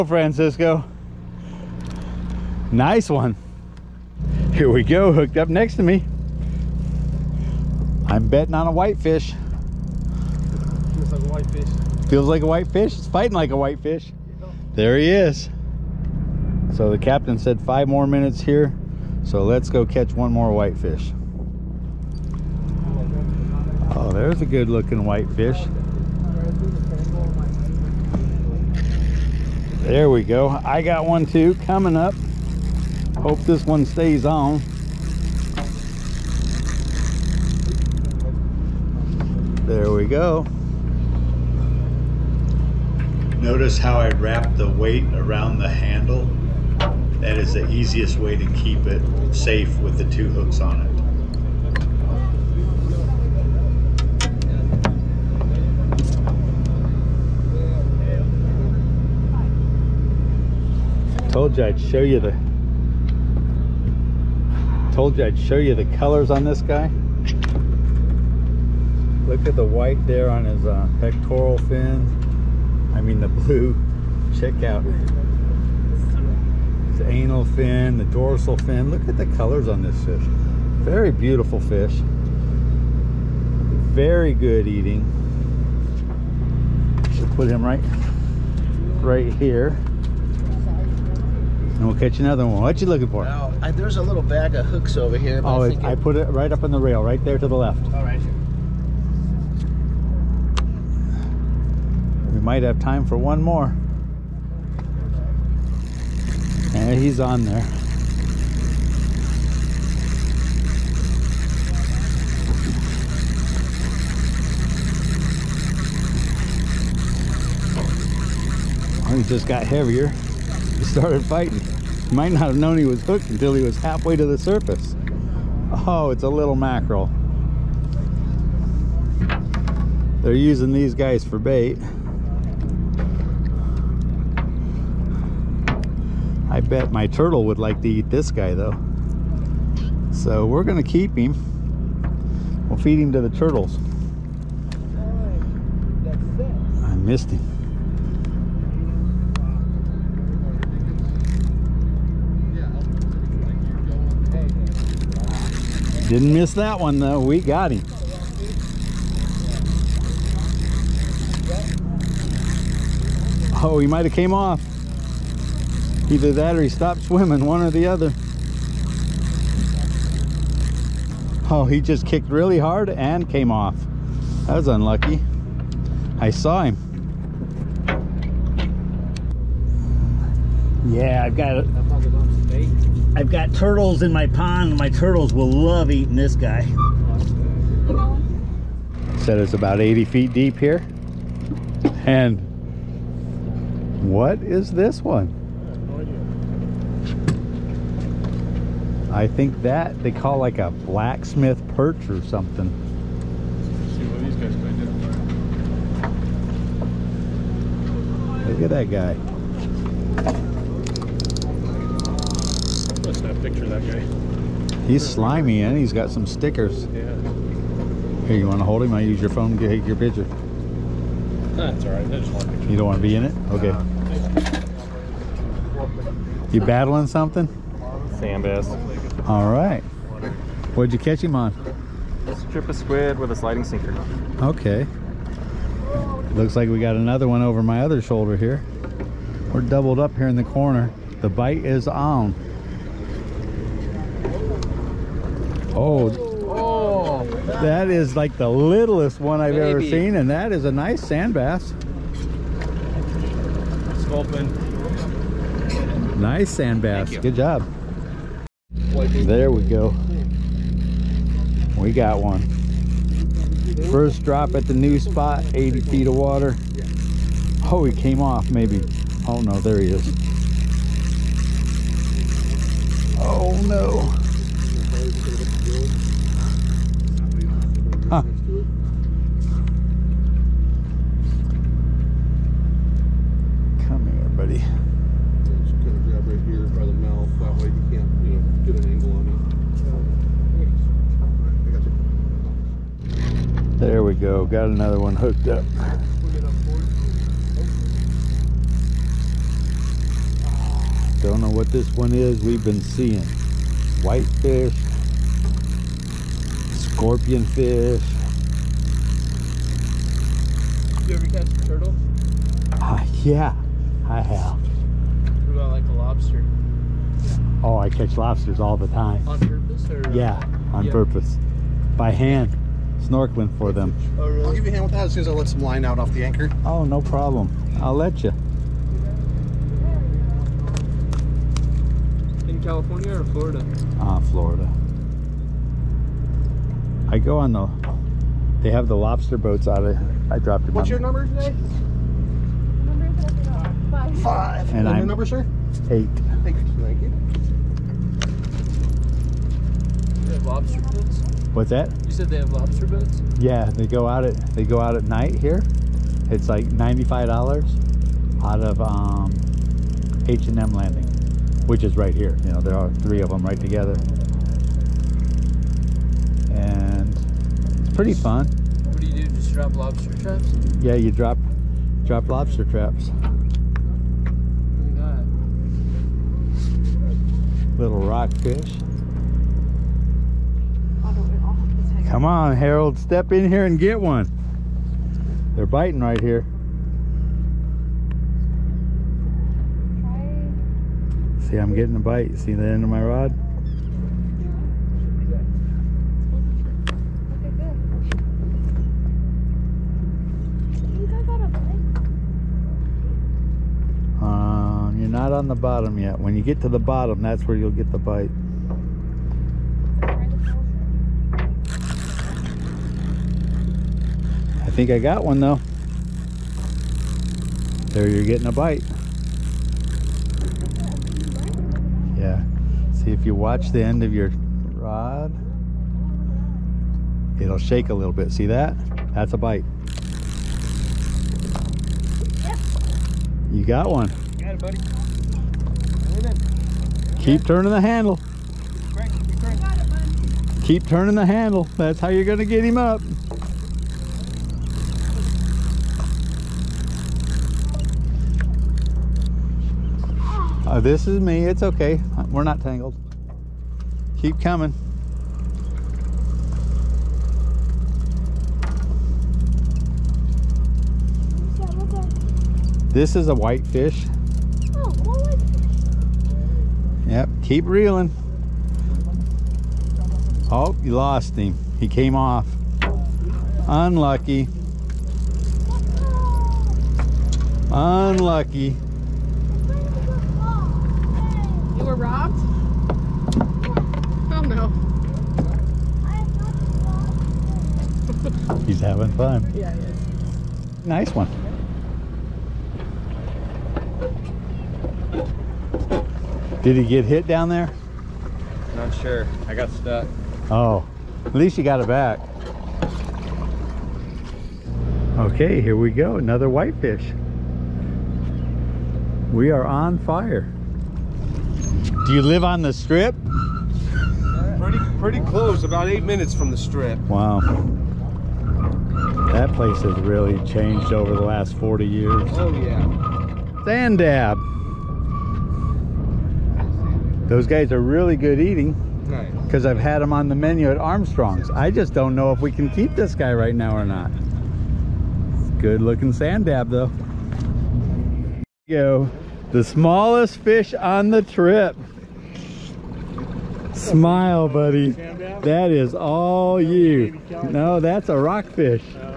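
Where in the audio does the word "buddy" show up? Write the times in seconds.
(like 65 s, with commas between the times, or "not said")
284 s, 434 s, 544 s.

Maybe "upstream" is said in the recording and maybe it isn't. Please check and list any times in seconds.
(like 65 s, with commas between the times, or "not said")
not said.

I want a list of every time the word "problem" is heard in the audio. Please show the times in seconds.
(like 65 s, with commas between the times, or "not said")
327 s.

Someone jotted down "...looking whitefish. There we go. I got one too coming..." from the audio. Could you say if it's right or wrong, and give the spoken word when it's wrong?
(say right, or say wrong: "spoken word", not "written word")
right.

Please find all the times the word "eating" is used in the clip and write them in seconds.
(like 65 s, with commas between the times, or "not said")
84 s, 185 s, 528 s.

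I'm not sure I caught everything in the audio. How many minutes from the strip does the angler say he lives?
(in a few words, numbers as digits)
8 minutes.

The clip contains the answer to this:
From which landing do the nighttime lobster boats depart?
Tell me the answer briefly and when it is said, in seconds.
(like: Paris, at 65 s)
H and M Landing, at 360 s.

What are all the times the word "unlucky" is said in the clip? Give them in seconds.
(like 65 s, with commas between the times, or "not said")
174 s, 473 s, 477 s.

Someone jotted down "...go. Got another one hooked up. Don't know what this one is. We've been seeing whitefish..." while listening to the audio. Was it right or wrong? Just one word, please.
right.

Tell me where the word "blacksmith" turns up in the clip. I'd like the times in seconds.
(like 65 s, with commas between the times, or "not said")
200 s.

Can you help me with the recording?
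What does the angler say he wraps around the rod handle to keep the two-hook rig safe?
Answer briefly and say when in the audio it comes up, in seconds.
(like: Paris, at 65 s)
The weight, at 44 s.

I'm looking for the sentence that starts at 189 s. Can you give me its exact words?
Said it's about 80 feet deep here.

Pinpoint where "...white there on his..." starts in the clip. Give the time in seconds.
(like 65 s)
69 s.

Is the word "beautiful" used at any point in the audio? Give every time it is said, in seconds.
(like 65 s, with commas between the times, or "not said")
81 s.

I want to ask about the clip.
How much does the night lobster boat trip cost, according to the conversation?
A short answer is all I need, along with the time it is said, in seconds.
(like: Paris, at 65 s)
$95, at 356 s.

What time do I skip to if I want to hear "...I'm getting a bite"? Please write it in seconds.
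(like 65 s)
391 s.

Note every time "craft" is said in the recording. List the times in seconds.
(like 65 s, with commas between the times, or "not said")
not said.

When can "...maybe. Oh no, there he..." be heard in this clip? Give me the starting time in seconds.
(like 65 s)
268 s.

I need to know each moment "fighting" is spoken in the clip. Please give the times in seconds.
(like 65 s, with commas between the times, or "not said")
13 s, 121 s.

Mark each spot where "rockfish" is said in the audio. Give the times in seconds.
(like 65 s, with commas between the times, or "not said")
378 s, 548 s.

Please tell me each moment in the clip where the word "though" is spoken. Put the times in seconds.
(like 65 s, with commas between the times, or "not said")
138 s, 156 s, 415 s, 536 s.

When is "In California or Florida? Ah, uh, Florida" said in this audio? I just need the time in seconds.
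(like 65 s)
332 s.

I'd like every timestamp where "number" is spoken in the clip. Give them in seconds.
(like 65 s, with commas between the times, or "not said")
340 s, 345 s.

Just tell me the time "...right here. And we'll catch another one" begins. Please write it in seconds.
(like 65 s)
89 s.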